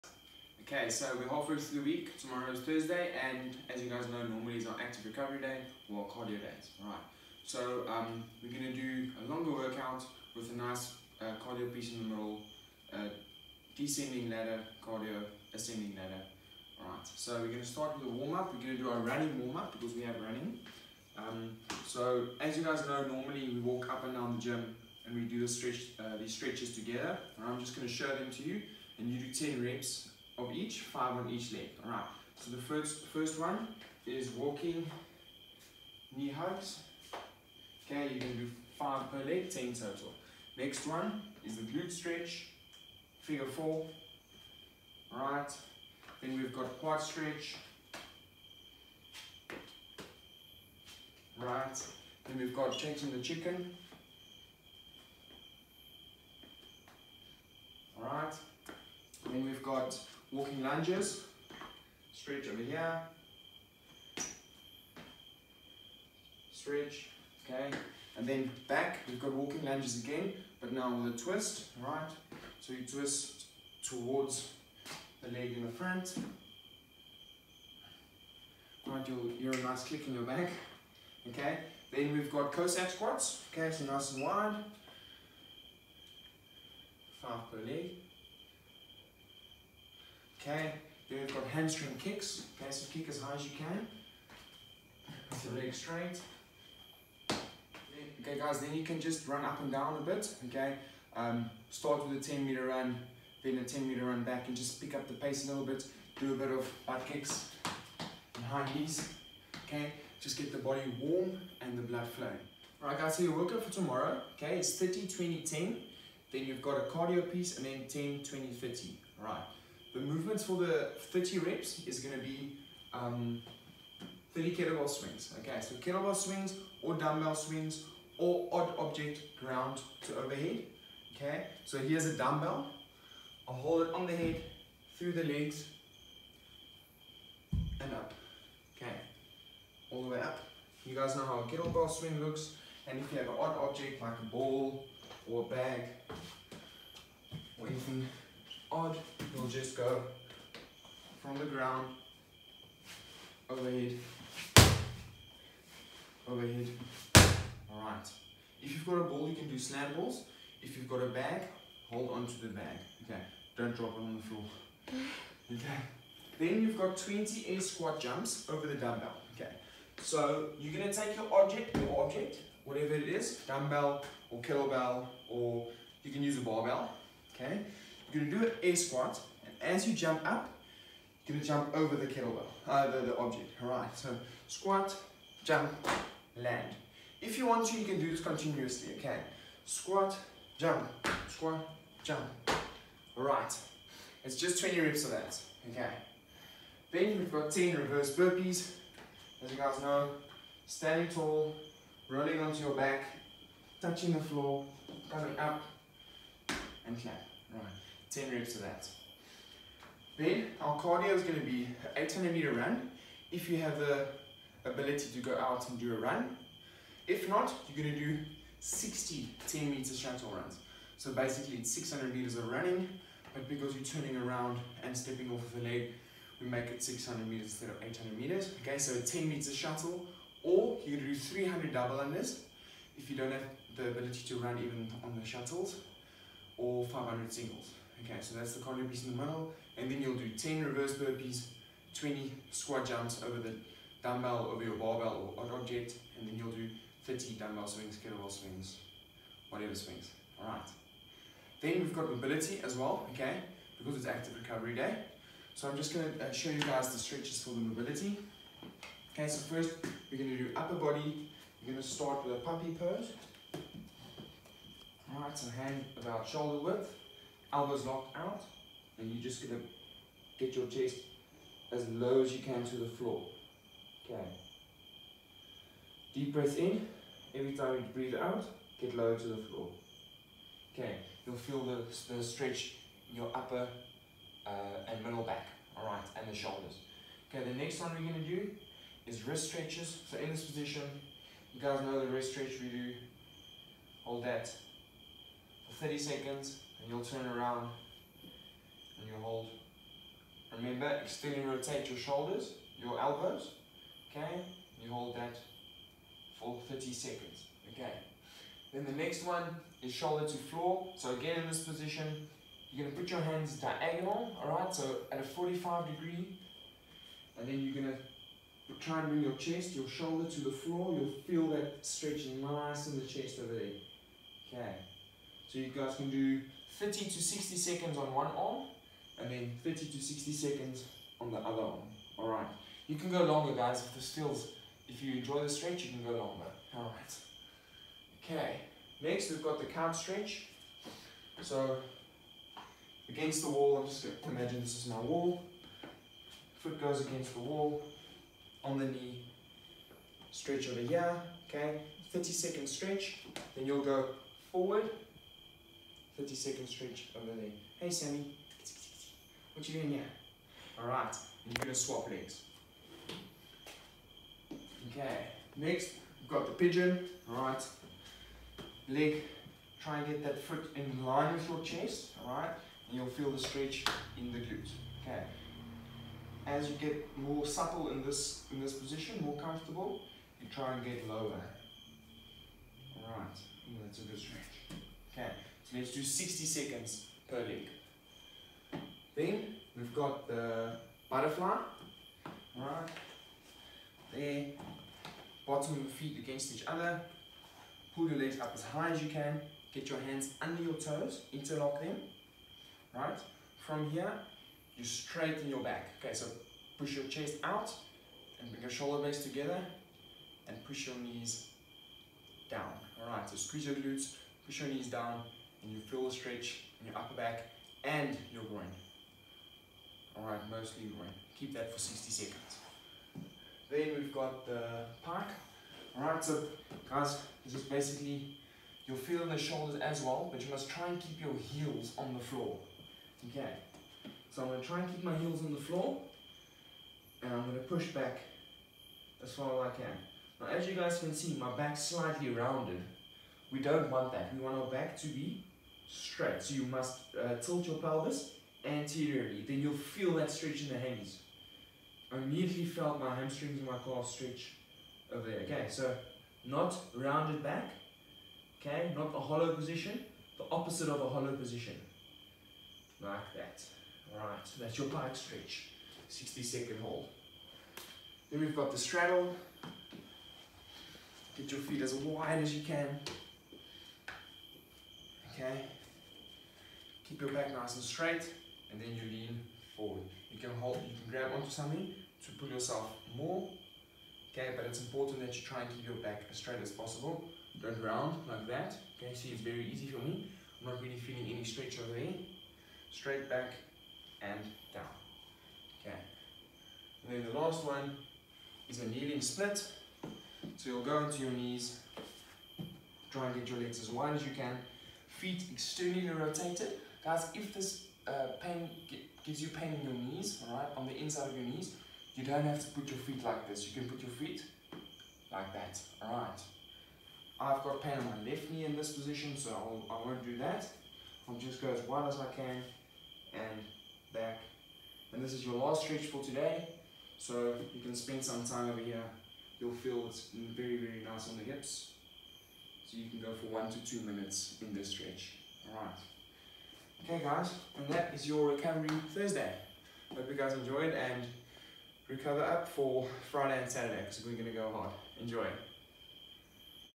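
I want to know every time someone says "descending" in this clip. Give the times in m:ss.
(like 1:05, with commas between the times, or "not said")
0:13.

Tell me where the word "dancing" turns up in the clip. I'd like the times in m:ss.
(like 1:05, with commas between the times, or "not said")
not said.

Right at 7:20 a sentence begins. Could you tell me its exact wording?
Now, as you guys can see, my back's slightly rounded.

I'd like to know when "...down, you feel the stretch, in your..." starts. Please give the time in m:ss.
6:54.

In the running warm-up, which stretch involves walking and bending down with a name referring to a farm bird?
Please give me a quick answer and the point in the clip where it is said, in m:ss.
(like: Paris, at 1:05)
Chasing the chicken, at 0:52.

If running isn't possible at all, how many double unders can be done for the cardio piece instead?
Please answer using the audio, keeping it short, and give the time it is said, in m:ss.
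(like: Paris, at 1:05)
300, at 3:51.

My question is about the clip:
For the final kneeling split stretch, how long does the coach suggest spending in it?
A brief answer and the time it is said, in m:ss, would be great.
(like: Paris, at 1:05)
1 to 2 minutes, at 8:53.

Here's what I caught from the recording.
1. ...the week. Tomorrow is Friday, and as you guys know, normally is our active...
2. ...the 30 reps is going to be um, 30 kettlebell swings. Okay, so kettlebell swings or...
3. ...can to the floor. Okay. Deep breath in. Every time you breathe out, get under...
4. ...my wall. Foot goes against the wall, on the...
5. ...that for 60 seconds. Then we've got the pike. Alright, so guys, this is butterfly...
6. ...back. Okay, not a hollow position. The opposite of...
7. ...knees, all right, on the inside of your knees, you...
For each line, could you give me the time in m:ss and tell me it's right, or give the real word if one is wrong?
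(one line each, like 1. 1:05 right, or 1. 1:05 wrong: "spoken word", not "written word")
1. 0:01 wrong: "Thursday", not "Friday"
2. 2:00 right
3. 4:32 wrong: "lower", not "under"
4. 5:44 right
5. 7:01 wrong: "basically", not "butterfly"
6. 7:37 right
7. 8:29 right.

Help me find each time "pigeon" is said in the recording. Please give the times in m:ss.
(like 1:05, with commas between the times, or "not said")
6:06.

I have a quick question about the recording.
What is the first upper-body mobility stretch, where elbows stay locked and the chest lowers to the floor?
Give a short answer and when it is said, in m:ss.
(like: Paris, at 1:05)
Puppy pose, at 4:22.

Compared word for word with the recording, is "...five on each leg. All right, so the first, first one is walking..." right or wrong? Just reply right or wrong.
right.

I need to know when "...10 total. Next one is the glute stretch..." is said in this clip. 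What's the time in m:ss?
0:39.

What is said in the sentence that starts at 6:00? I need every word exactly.
Alright, and you're gonna swap legs.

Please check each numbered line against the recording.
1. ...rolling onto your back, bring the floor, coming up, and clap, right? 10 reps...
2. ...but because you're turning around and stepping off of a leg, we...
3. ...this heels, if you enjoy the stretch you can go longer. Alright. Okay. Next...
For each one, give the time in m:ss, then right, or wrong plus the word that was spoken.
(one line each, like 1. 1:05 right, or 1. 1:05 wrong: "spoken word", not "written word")
1. 3:22 wrong: "touching", not "bring"
2. 3:43 right
3. 5:33 wrong: "feels", not "heels".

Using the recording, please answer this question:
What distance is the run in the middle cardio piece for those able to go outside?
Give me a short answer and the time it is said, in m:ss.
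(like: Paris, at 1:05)
800 meters, at 3:31.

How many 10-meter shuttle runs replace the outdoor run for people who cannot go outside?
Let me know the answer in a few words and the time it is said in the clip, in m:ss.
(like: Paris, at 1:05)
60, at 3:38.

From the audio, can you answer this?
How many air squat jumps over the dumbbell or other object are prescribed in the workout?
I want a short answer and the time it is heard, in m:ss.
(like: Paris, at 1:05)
20, at 2:46.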